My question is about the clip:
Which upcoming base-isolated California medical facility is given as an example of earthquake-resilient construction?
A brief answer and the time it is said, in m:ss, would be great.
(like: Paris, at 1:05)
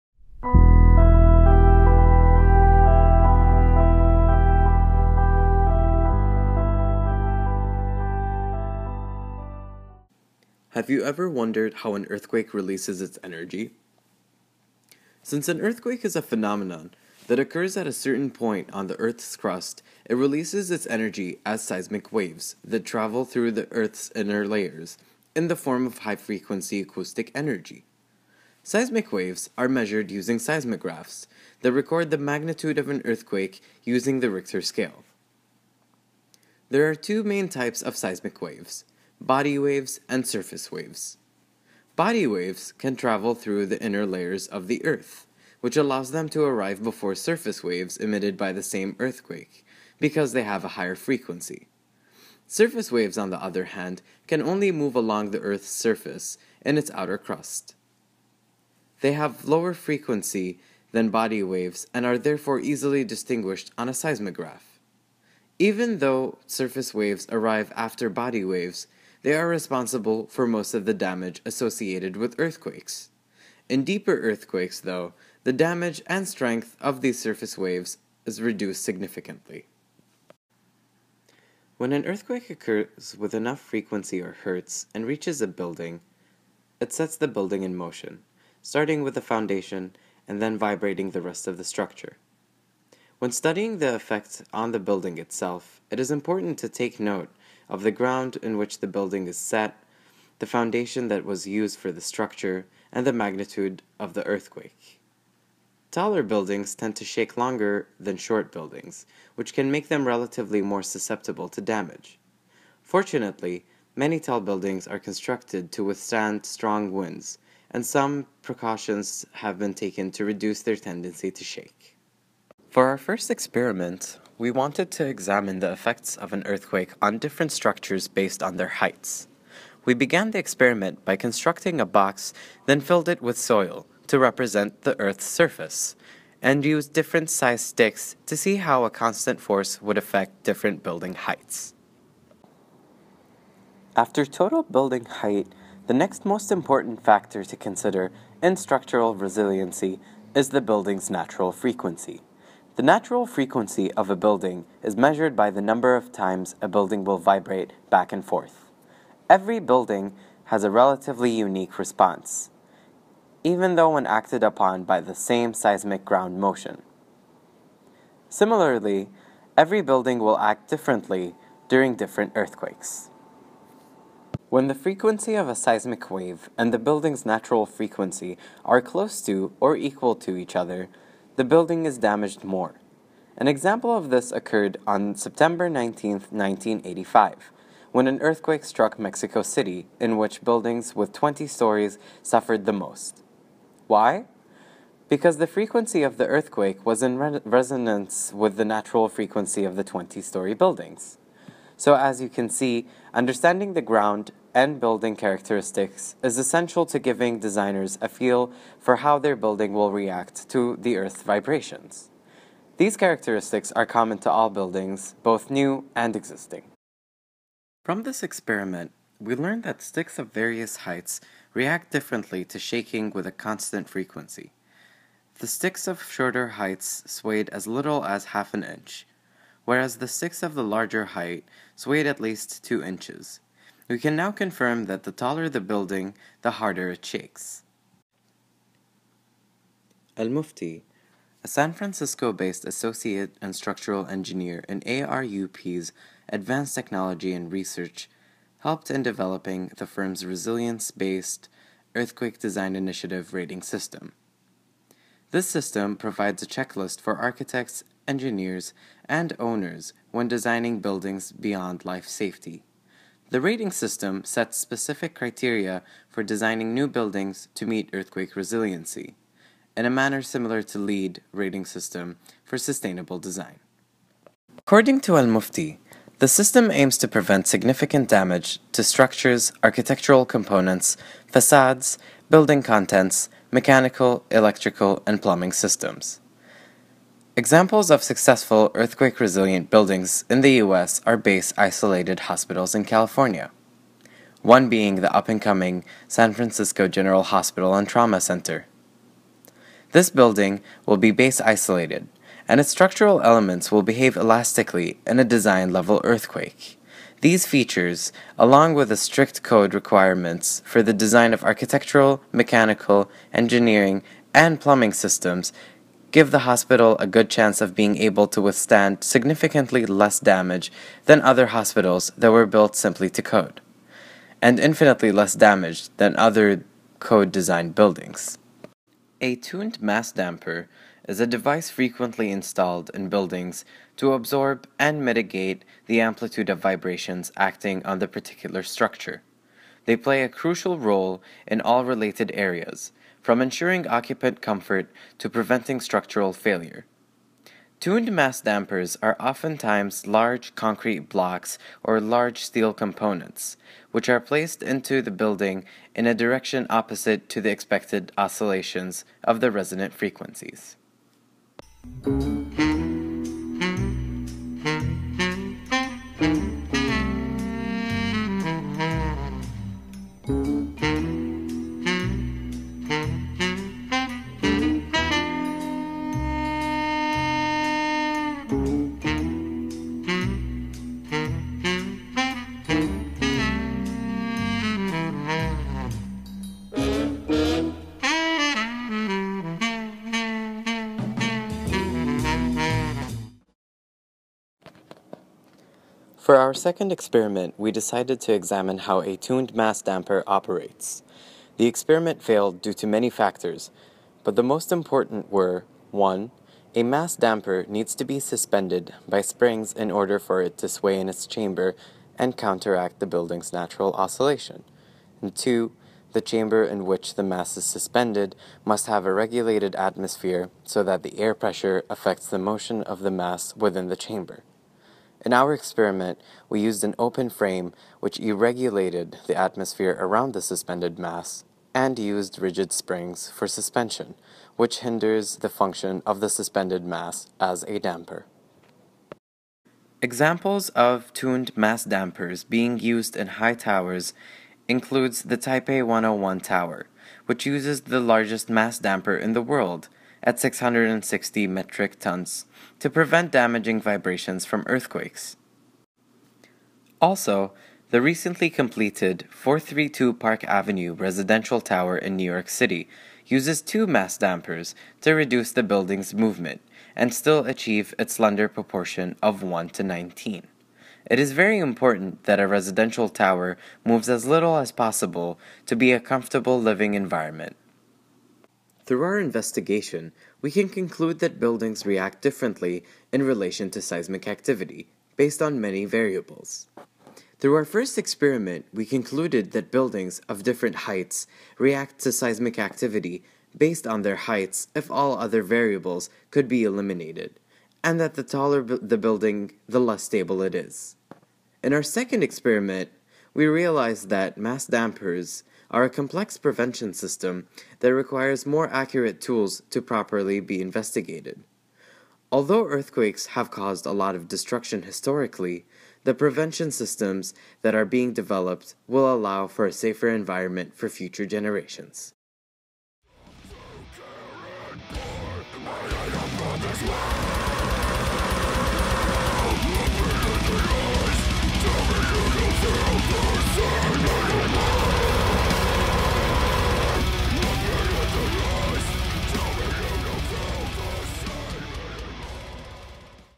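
San Francisco General Hospital and Trauma Center, at 4:56.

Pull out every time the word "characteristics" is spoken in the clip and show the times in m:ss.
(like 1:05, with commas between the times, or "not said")
3:25, 3:32.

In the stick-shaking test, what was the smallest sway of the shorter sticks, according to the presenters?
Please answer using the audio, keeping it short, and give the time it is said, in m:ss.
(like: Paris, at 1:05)
half an inch, at 3:48.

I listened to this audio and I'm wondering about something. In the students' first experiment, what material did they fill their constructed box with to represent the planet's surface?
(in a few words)
soil.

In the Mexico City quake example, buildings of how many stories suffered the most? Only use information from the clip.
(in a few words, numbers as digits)
20.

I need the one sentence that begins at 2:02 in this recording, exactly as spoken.
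For our first experiment, we wanted to examine the effects of an earthquake on different structures based on their heights.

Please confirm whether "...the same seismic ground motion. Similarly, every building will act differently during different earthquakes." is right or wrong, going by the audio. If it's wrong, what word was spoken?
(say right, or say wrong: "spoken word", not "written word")
right.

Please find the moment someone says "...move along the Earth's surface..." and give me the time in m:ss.
0:54.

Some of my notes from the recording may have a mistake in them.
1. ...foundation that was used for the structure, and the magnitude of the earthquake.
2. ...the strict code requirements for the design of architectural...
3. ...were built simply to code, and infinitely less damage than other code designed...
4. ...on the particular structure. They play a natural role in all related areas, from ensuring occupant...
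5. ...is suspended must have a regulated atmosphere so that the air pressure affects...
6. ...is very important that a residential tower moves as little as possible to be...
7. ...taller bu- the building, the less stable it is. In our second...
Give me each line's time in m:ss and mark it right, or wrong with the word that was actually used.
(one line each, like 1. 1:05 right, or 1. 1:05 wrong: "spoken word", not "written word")
1. 1:40 right
2. 5:08 right
3. 5:22 right
4. 5:37 wrong: "crucial", not "natural"
5. 6:57 right
6. 7:51 right
7. 8:18 right.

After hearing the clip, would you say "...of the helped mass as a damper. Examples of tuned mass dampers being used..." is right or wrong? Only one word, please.
wrong.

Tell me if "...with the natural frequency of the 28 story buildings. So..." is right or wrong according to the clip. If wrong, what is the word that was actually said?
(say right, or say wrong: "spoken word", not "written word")
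wrong: "20", not "28".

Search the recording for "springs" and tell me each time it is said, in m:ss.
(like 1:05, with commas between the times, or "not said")
6:49, 7:12.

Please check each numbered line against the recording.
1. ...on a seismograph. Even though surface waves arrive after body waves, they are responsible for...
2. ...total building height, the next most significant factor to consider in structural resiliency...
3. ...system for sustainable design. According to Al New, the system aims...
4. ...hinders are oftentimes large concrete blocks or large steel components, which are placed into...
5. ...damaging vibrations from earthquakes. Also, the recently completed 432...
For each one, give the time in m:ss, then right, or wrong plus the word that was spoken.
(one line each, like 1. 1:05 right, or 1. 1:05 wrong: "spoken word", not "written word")
1. 1:03 right
2. 2:24 wrong: "important", not "significant"
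3. 4:31 wrong: "Mufti", not "New"
4. 5:48 wrong: "dampers", not "hinders"
5. 7:33 right.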